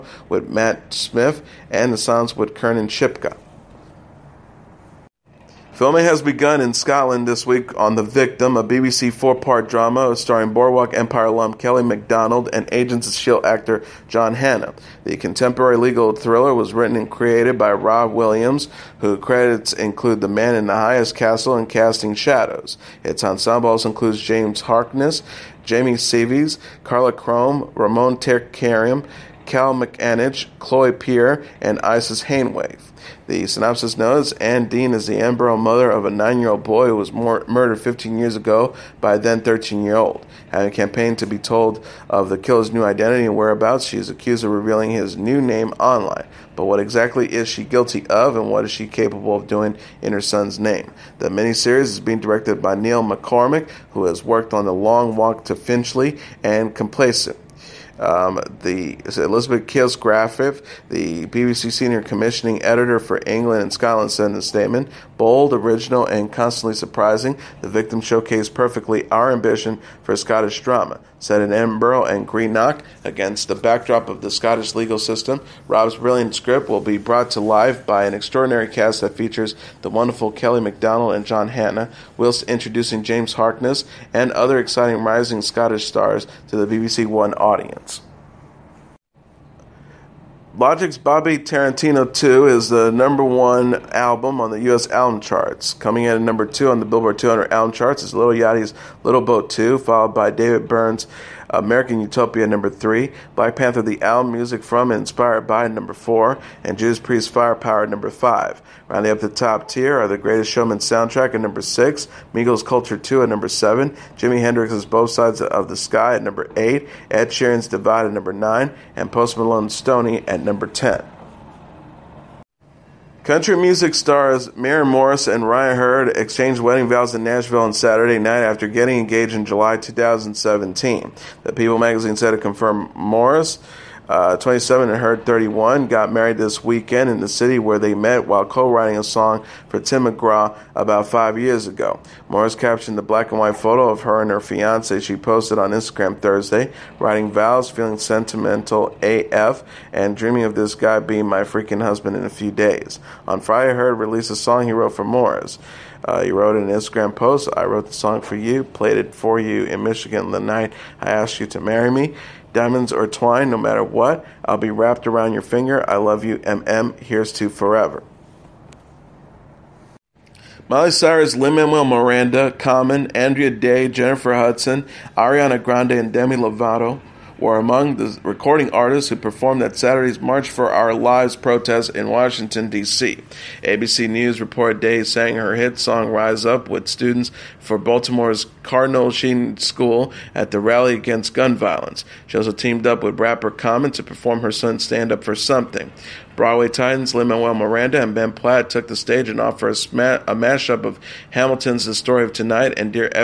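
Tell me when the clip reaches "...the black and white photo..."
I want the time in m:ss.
2:22.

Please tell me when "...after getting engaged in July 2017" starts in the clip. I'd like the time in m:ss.
2:08.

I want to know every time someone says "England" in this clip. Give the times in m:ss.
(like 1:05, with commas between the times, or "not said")
1:03.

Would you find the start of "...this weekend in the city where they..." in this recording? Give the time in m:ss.
2:16.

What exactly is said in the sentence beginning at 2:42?
Diamonds or twine, no matter what.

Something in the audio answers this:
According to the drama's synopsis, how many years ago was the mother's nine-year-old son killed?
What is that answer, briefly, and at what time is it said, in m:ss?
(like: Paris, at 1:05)
15, at 0:37.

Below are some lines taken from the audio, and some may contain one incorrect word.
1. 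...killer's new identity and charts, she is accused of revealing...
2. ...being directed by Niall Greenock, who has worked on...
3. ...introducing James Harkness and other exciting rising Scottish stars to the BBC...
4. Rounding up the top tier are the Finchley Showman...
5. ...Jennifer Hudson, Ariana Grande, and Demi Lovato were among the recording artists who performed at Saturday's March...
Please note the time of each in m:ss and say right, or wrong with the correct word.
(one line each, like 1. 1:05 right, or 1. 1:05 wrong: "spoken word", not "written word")
1. 0:42 wrong: "whereabouts", not "charts"
2. 0:51 wrong: "MacCormick", not "Greenock"
3. 1:22 right
4. 1:48 wrong: "Greatest", not "Finchley"
5. 2:53 right.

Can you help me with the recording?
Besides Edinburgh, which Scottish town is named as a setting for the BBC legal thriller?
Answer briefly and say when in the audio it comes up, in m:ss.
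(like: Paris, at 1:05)
Greenock, at 1:12.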